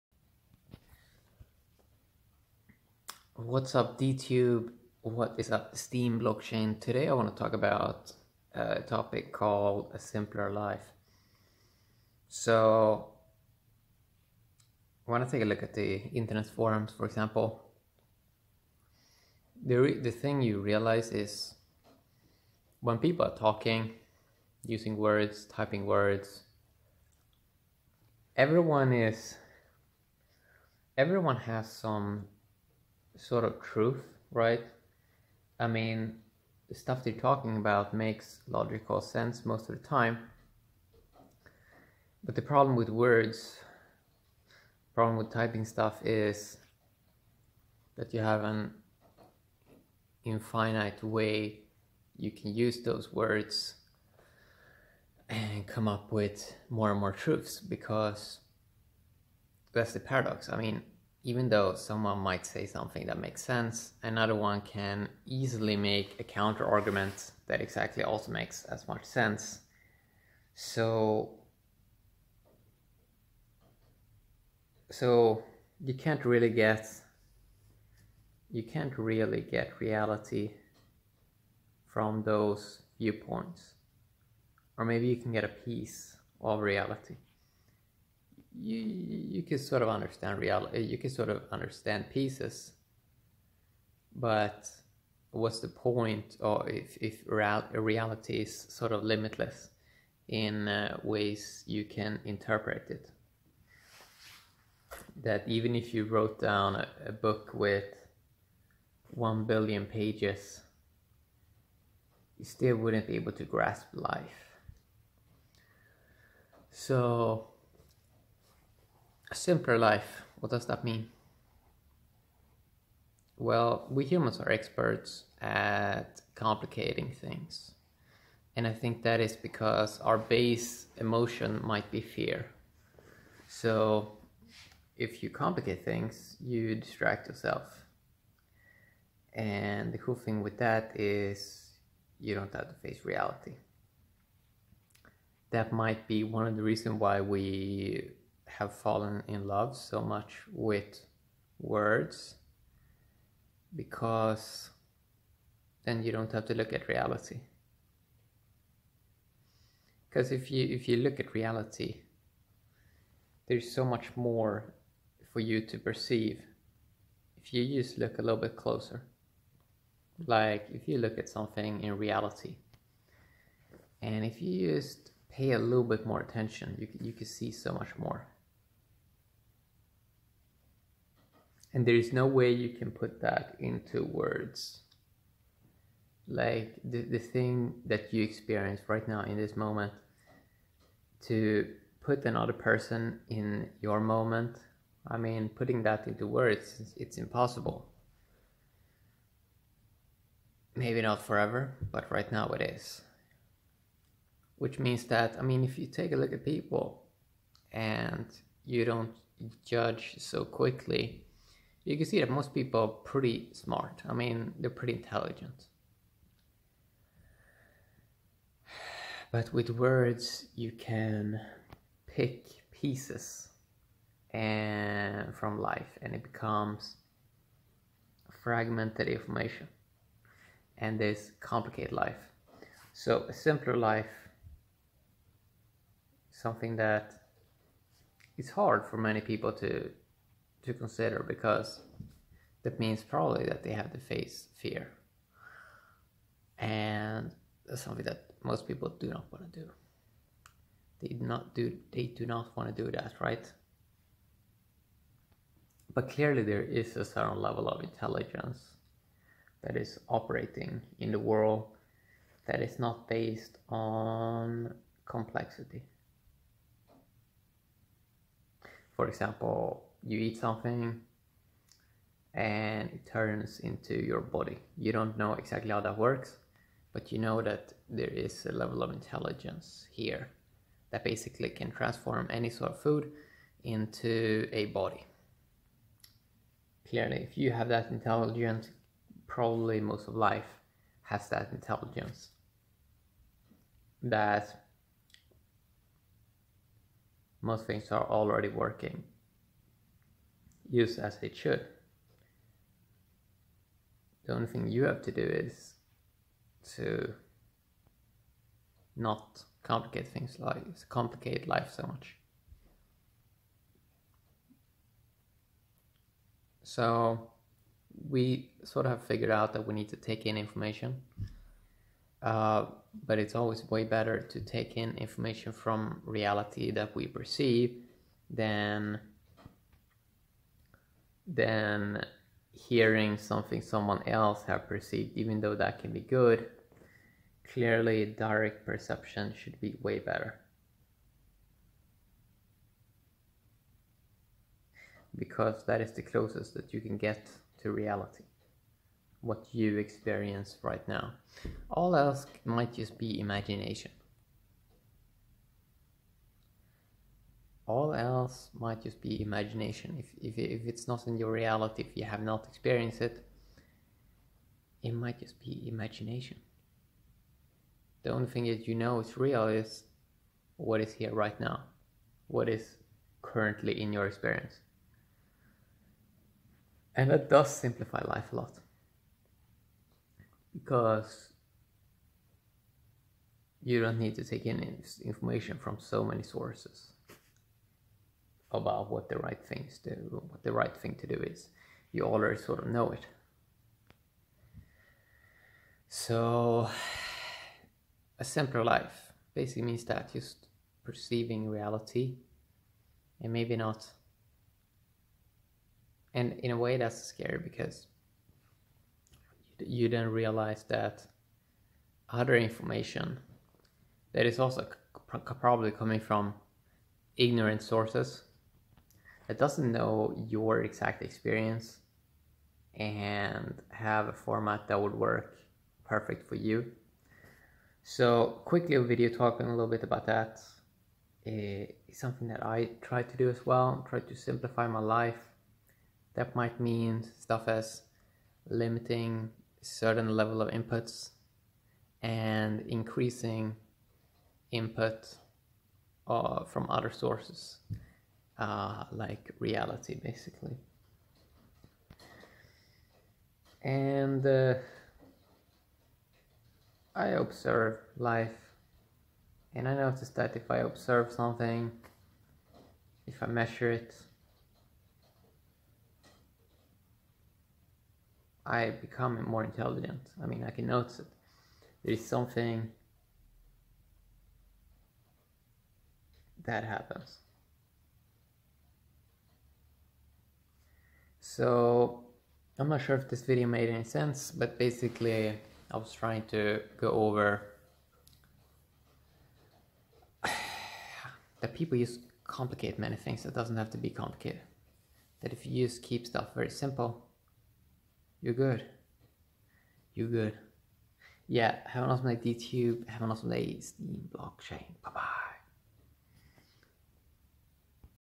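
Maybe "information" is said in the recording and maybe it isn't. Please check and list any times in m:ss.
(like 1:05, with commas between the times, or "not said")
3:49, 5:20, 5:24, 6:25, 6:52.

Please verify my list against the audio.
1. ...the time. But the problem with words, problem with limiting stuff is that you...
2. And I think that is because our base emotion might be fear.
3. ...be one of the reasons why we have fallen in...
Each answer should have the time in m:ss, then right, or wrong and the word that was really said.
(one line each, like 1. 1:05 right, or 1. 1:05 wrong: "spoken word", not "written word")
1. 0:39 wrong: "typing", not "limiting"
2. 2:08 right
3. 2:26 right.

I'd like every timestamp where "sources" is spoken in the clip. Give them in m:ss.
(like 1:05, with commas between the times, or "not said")
6:26, 6:57, 7:26.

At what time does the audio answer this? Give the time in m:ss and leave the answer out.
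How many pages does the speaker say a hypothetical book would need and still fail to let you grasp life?
1:49.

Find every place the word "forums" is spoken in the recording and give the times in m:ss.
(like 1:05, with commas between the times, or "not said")
0:16.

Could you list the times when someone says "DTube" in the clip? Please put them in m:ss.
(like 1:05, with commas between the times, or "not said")
0:03, 8:22.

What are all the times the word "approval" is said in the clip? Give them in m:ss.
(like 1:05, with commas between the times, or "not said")
not said.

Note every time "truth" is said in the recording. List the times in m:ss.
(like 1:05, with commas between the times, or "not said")
0:33, 0:57.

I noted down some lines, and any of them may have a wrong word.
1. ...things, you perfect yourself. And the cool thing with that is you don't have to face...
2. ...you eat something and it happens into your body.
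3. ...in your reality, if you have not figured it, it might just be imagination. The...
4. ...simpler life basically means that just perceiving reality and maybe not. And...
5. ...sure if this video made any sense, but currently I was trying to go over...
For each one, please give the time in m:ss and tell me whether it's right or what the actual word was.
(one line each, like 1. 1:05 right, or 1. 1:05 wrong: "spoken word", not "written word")
1. 2:15 wrong: "distract", not "perfect"
2. 4:30 wrong: "turns", not "happens"
3. 6:01 wrong: "experienced", not "figured"
4. 6:38 right
5. 8:02 wrong: "basically", not "currently".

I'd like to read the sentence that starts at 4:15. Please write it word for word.
But clearly there is a certain level of intelligence that is operating in the world that is not based on complexity.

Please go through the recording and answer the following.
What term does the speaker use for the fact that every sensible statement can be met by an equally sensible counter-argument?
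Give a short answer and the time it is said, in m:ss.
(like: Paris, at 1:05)
paradox, at 0:59.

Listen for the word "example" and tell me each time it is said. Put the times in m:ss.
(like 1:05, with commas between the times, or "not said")
0:17, 4:29.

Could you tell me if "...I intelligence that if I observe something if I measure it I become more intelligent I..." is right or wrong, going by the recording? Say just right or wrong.
wrong.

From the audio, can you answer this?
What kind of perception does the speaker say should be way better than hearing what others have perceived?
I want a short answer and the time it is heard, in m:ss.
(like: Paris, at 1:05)
direct perception, at 5:38.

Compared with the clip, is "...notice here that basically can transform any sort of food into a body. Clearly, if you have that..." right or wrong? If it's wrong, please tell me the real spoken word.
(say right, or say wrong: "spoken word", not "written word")
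wrong: "intelligence", not "notice".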